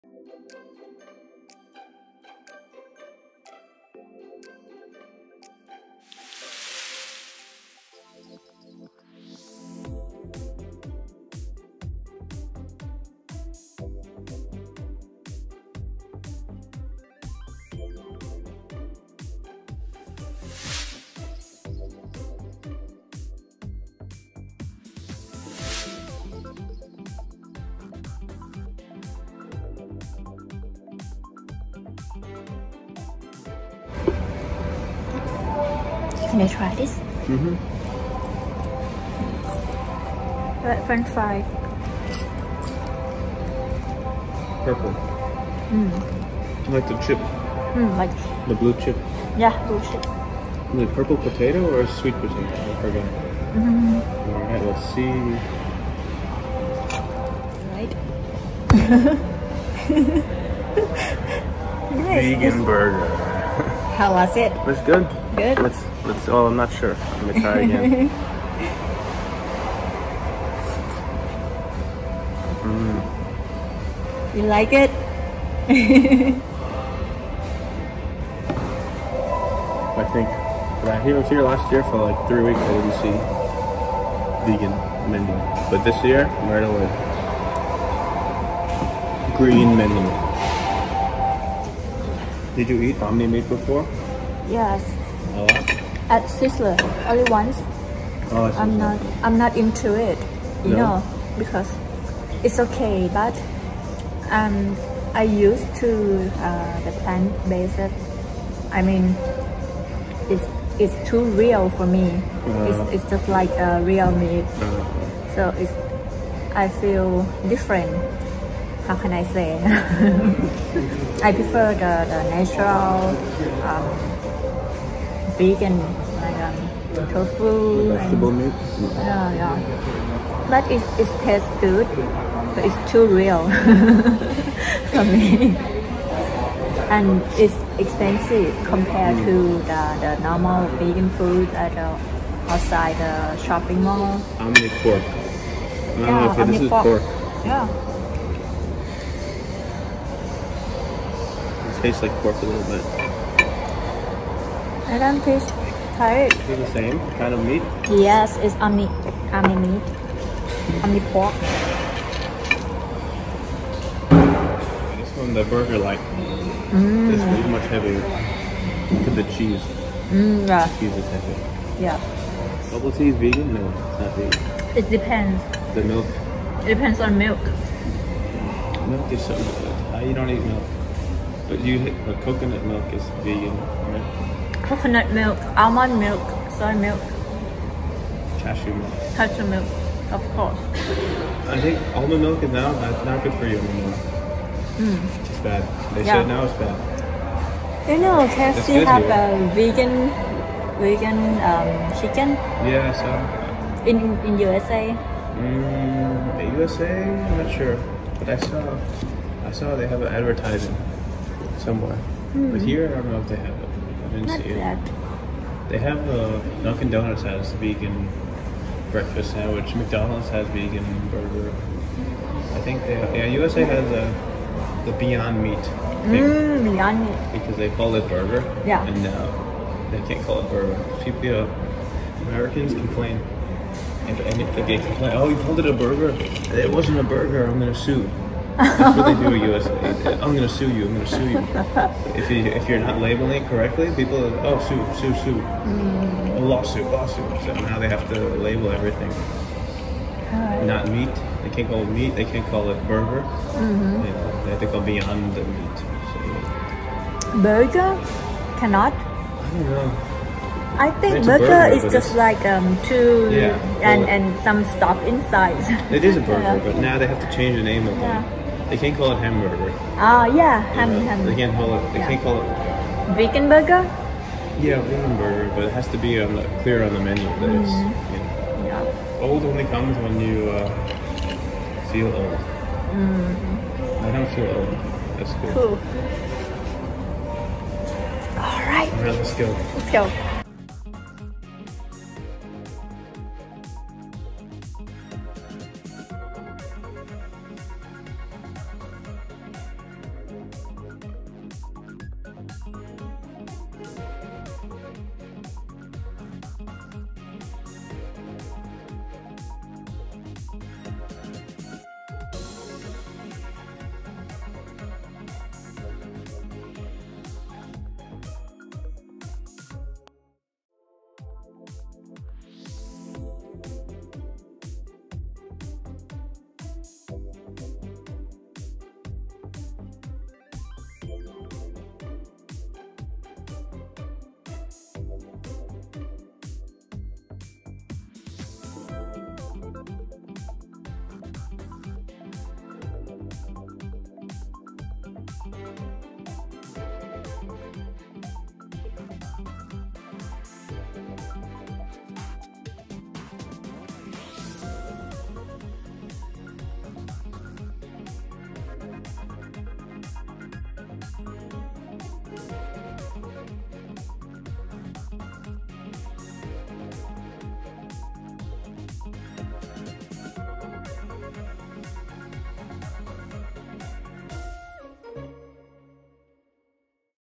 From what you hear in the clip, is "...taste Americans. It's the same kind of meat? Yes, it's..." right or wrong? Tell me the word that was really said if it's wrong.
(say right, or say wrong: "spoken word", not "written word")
wrong: "Thai", not "Americans".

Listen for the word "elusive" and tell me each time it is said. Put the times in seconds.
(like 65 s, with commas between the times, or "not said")
not said.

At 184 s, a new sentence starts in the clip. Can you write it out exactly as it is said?
Coconut milk, almond milk, soy milk.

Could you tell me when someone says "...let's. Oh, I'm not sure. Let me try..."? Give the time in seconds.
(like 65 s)
66 s.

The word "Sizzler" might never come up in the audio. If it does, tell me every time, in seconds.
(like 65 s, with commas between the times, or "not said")
96 s.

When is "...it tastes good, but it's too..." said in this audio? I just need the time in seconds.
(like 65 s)
130 s.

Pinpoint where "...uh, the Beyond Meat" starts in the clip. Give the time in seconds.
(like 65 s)
224 s.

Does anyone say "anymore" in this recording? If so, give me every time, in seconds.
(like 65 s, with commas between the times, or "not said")
193 s.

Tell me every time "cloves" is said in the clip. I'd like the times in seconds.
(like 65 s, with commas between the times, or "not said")
not said.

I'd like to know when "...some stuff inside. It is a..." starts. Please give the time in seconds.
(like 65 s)
264 s.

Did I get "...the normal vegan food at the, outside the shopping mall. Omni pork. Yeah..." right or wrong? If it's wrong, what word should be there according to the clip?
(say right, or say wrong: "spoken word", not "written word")
right.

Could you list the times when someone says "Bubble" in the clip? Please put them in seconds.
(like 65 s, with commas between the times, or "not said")
172 s.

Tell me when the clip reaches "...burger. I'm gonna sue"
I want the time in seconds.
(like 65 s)
237 s.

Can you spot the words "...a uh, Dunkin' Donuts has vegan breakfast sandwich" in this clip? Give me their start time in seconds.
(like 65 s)
216 s.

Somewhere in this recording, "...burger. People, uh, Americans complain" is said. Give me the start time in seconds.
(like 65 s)
230 s.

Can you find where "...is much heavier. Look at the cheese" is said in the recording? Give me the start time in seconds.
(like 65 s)
167 s.